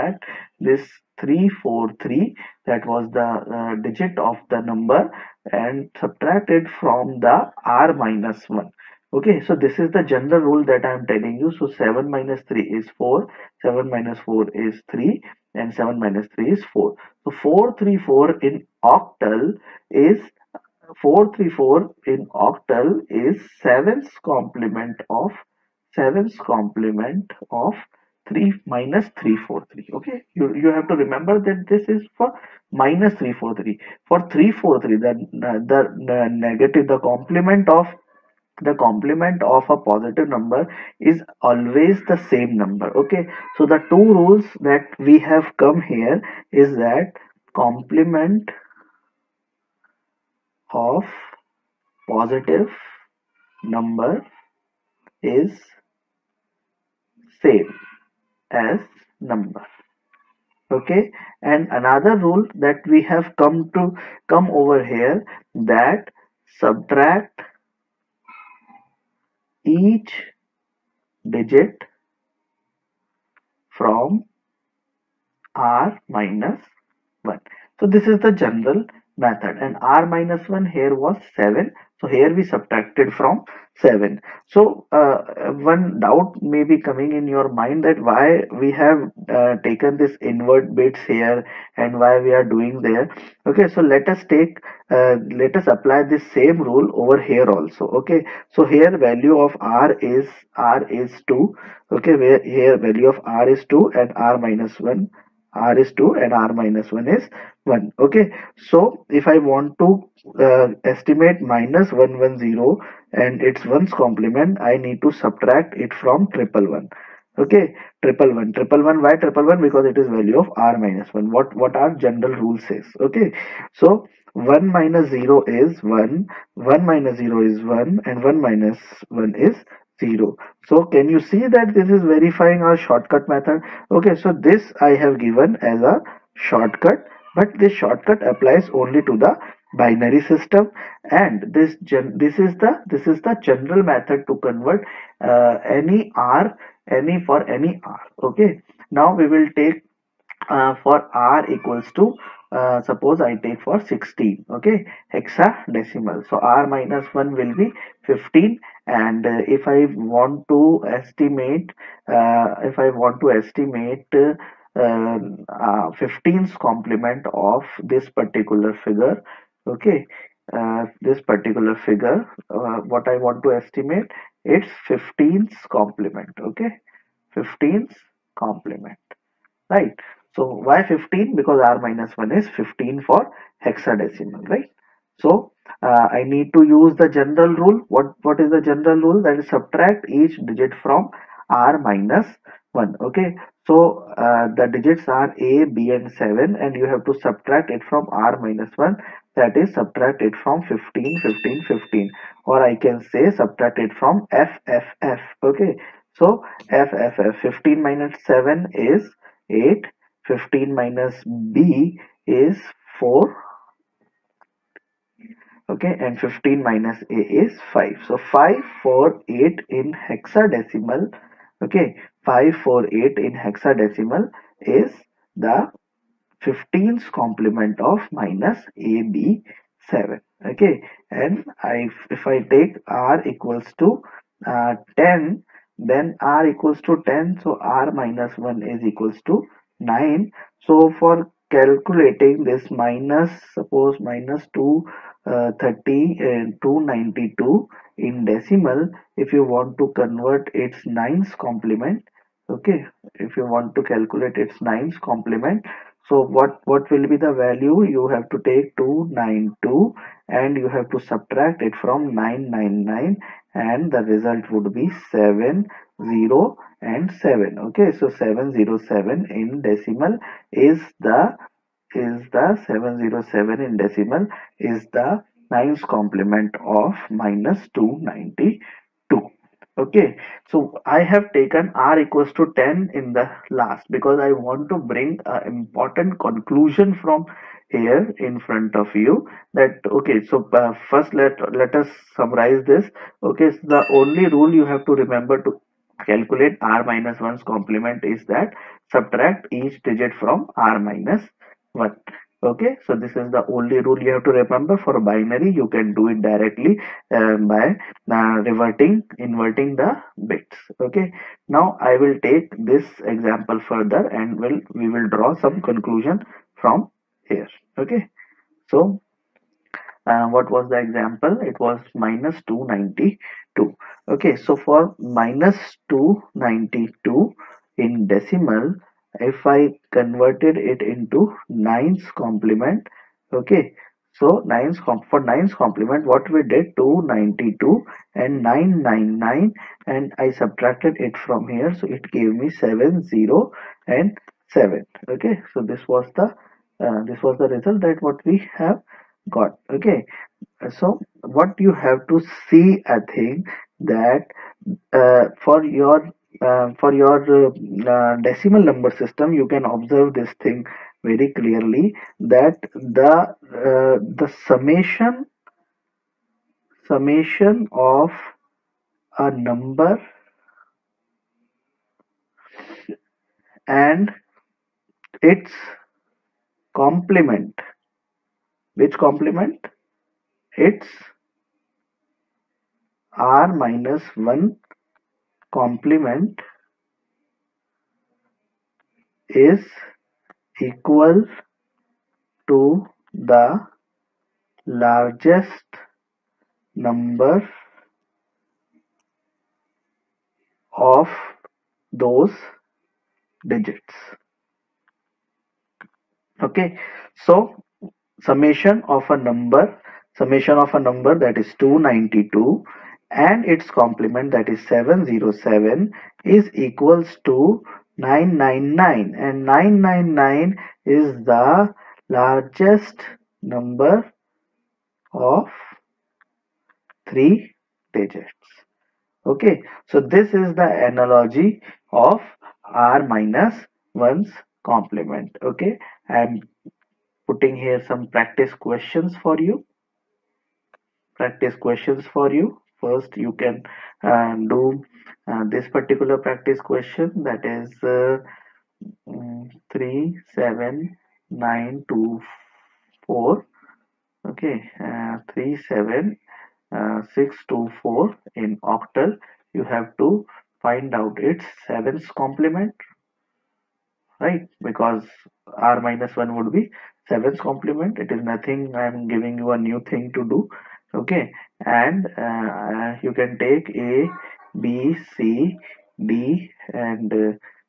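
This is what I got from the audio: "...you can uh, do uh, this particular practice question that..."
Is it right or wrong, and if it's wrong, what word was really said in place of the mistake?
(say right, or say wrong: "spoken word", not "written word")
right.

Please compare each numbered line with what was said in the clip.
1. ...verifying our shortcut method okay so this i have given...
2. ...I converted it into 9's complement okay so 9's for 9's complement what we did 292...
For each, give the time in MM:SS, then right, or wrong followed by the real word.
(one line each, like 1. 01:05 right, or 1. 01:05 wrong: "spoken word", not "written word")
1. 02:12 right
2. 05:29 right.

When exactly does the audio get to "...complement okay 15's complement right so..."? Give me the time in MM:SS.
02:55.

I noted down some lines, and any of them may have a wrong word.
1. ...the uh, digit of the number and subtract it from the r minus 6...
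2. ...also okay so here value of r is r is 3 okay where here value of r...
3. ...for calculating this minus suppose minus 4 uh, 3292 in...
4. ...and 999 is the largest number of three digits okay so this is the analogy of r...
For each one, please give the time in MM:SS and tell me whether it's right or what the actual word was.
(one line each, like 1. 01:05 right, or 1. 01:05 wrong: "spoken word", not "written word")
1. 00:03 wrong: "1", not "6"
2. 01:37 wrong: "2", not "3"
3. 04:00 wrong: "2", not "4"
4. 06:59 right.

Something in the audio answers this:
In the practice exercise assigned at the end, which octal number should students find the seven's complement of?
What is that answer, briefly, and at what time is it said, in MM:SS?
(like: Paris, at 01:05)
37624, at 07:35.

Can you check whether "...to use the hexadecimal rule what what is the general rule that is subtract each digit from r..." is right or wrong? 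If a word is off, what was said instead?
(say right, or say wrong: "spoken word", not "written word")
wrong: "general", not "hexadecimal".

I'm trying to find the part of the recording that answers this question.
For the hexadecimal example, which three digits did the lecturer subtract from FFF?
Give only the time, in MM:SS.
03:15.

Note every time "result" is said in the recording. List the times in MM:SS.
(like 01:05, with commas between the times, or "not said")
04:24, 05:47.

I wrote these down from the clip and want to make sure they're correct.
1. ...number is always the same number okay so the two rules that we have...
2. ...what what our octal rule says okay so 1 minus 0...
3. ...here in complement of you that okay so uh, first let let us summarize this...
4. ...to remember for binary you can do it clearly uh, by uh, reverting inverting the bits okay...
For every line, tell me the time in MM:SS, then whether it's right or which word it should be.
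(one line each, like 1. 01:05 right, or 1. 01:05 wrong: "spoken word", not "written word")
1. 00:40 right
2. 02:01 wrong: "general", not "octal"
3. 04:47 wrong: "front", not "complement"
4. 05:04 wrong: "directly", not "clearly".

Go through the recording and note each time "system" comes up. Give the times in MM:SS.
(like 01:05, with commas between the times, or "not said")
02:20, 05:58.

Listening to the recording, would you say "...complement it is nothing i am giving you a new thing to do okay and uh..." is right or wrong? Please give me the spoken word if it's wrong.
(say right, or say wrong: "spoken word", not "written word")
right.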